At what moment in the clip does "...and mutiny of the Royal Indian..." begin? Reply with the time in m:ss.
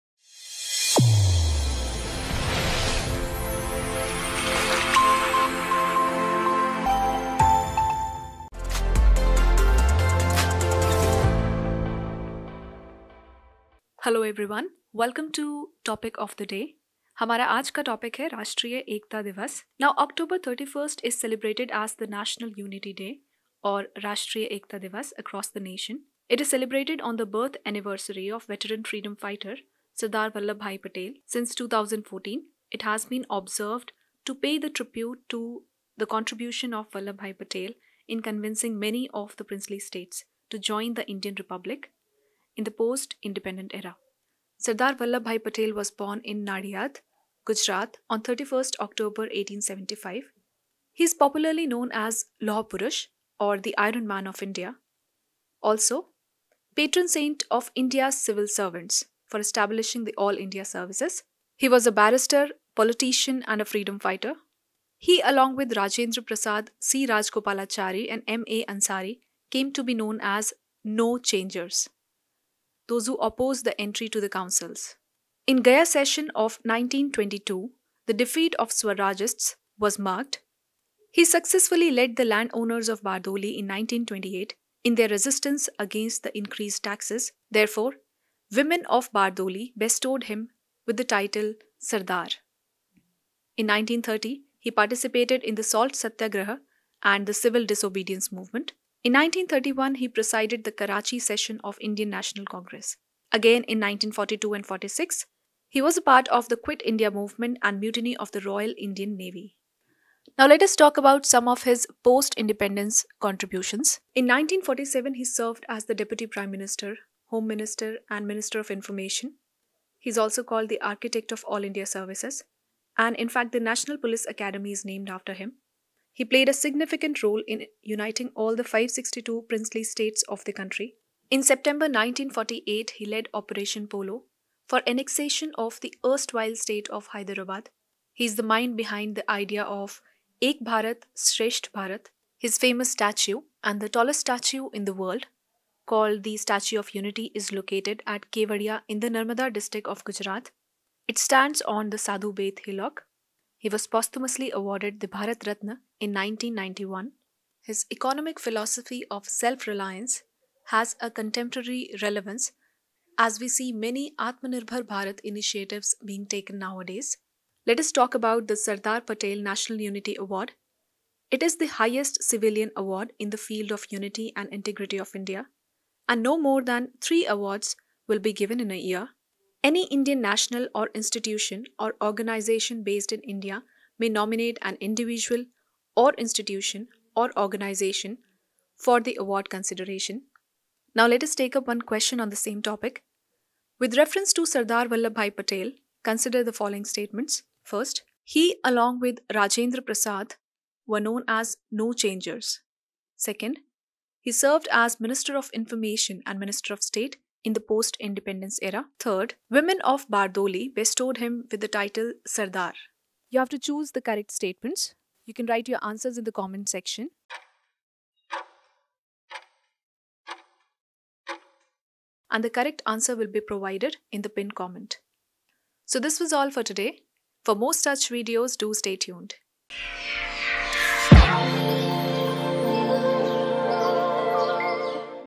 1:47.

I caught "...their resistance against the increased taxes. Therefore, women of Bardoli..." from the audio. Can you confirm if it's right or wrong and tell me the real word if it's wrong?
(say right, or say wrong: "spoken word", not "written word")
right.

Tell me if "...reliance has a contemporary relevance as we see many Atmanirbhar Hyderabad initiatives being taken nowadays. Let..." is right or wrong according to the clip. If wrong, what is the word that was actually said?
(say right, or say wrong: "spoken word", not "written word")
wrong: "Bharat", not "Hyderabad".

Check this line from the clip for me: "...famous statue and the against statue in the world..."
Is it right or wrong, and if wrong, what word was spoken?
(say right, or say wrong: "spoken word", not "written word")
wrong: "tallest", not "against".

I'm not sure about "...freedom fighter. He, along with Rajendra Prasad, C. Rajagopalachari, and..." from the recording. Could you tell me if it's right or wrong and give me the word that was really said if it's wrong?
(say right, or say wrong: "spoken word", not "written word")
right.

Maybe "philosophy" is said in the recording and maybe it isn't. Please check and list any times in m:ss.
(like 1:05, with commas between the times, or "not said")
2:38.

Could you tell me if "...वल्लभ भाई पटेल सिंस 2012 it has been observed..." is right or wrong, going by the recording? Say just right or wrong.
wrong.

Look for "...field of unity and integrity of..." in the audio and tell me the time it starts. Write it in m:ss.
2:53.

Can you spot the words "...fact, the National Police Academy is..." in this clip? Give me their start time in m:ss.
2:03.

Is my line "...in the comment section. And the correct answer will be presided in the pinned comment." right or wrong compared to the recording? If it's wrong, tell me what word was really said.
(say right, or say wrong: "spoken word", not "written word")
wrong: "provided", not "presided".